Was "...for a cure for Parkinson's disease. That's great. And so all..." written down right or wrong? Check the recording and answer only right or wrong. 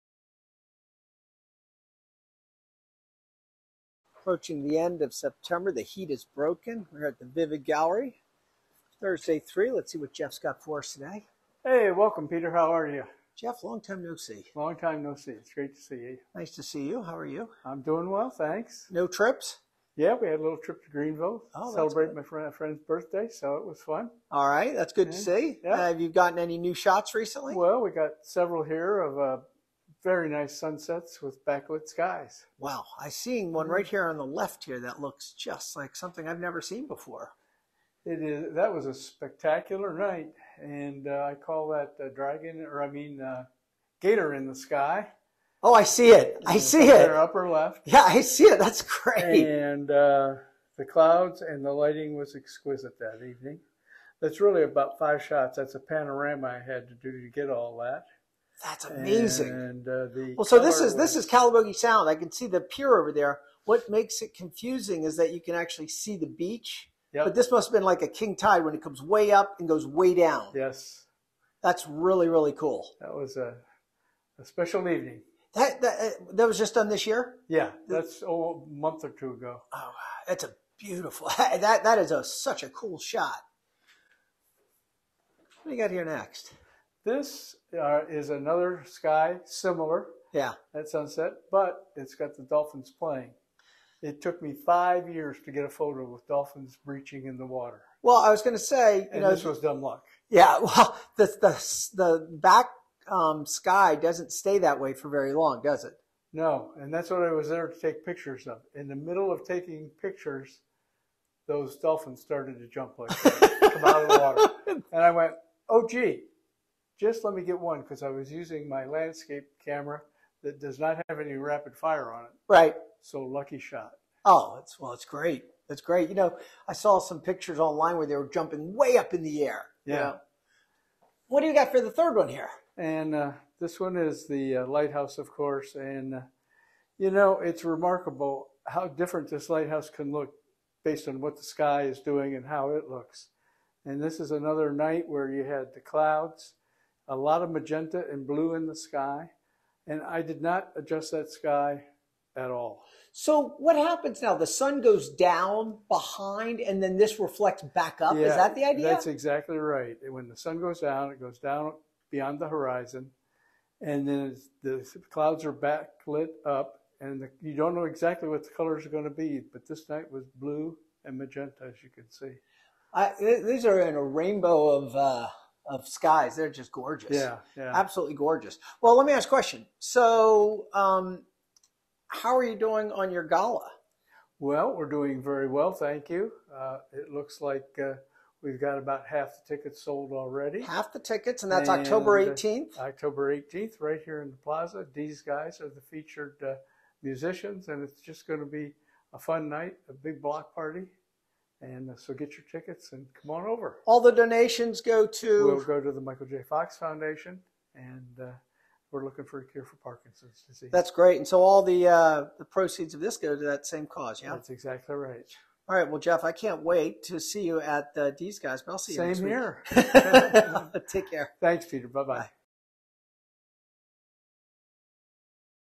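right.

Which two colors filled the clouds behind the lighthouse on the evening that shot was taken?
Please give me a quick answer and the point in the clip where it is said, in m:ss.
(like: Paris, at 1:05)
Blue and magenta, at 2:50.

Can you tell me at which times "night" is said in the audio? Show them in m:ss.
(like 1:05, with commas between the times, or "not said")
0:39, 2:24, 2:49, 3:19.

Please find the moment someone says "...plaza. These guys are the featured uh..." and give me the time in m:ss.
3:14.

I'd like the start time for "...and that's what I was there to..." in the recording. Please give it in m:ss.
1:46.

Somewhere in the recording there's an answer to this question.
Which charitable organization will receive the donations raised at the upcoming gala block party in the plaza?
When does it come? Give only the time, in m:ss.
3:26.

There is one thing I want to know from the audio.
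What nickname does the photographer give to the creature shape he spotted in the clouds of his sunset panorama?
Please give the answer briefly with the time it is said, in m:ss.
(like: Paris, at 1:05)
Gator in the sky, at 0:44.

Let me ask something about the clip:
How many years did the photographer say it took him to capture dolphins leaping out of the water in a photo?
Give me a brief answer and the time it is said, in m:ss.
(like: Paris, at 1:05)
5, at 1:34.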